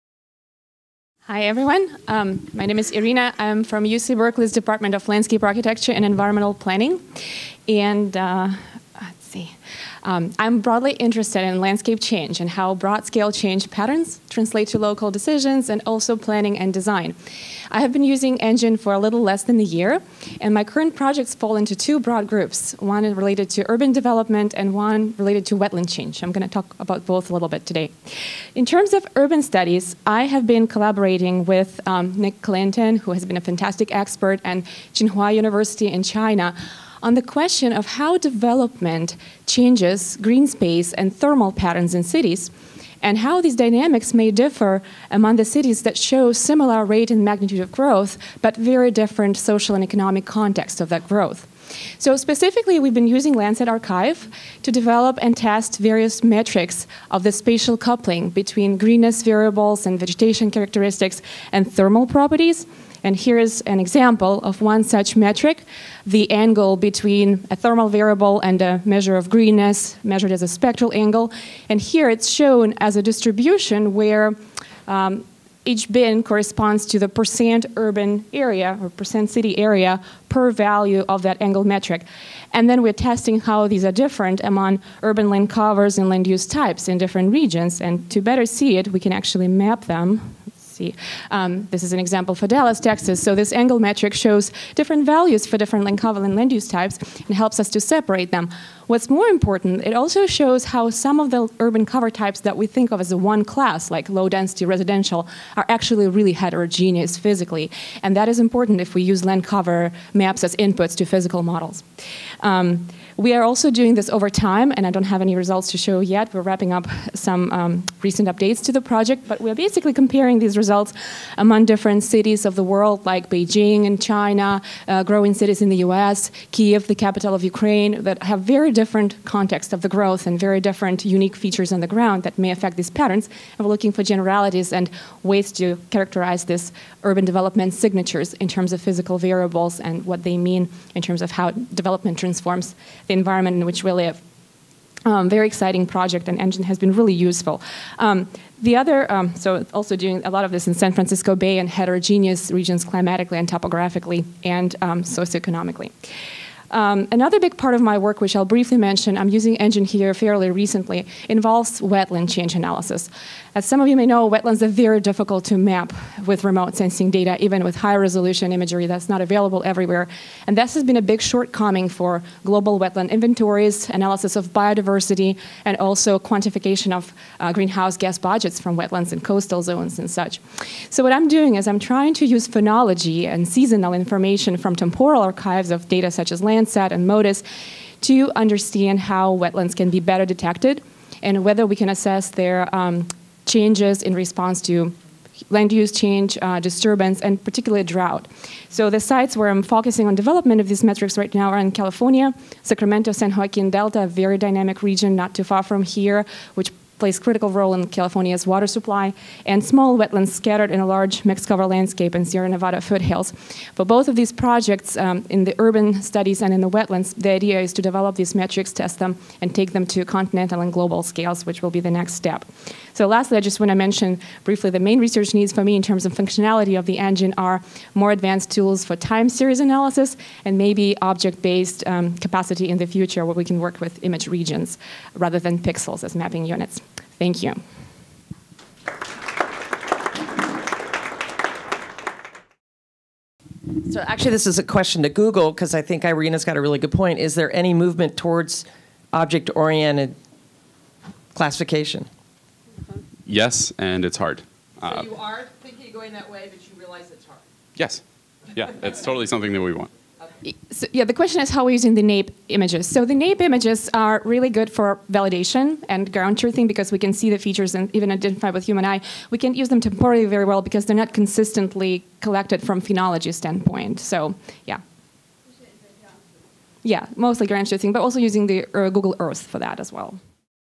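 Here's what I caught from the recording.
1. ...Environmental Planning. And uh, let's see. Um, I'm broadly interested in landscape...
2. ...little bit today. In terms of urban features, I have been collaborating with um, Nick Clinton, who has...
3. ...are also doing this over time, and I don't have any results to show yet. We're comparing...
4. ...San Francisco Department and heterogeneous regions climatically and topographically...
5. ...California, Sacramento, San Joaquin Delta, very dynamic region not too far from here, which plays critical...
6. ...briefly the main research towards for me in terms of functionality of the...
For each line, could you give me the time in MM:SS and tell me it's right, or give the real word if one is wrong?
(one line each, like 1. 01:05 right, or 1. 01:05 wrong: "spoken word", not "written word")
1. 00:06 right
2. 00:27 wrong: "studies", not "features"
3. 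01:53 wrong: "wrapping", not "comparing"
4. 02:30 wrong: "Bay", not "Department"
5. 03:21 right
6. 03:44 wrong: "needs", not "towards".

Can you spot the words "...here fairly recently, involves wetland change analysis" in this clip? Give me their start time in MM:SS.
02:39.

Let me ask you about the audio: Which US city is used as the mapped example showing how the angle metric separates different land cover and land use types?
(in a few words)
Dallas, Texas.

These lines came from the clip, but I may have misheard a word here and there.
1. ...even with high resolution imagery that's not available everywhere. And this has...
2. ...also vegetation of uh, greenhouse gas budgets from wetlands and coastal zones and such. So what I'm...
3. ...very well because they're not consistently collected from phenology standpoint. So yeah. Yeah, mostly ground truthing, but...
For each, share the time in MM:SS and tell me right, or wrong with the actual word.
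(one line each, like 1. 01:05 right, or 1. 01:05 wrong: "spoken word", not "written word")
1. 02:47 right
2. 02:55 wrong: "quantification", not "vegetation"
3. 04:30 right.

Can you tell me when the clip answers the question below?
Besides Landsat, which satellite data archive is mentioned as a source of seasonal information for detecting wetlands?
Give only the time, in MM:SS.
03:07.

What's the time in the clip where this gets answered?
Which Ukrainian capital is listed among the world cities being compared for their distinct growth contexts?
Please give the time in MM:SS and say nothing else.
02:06.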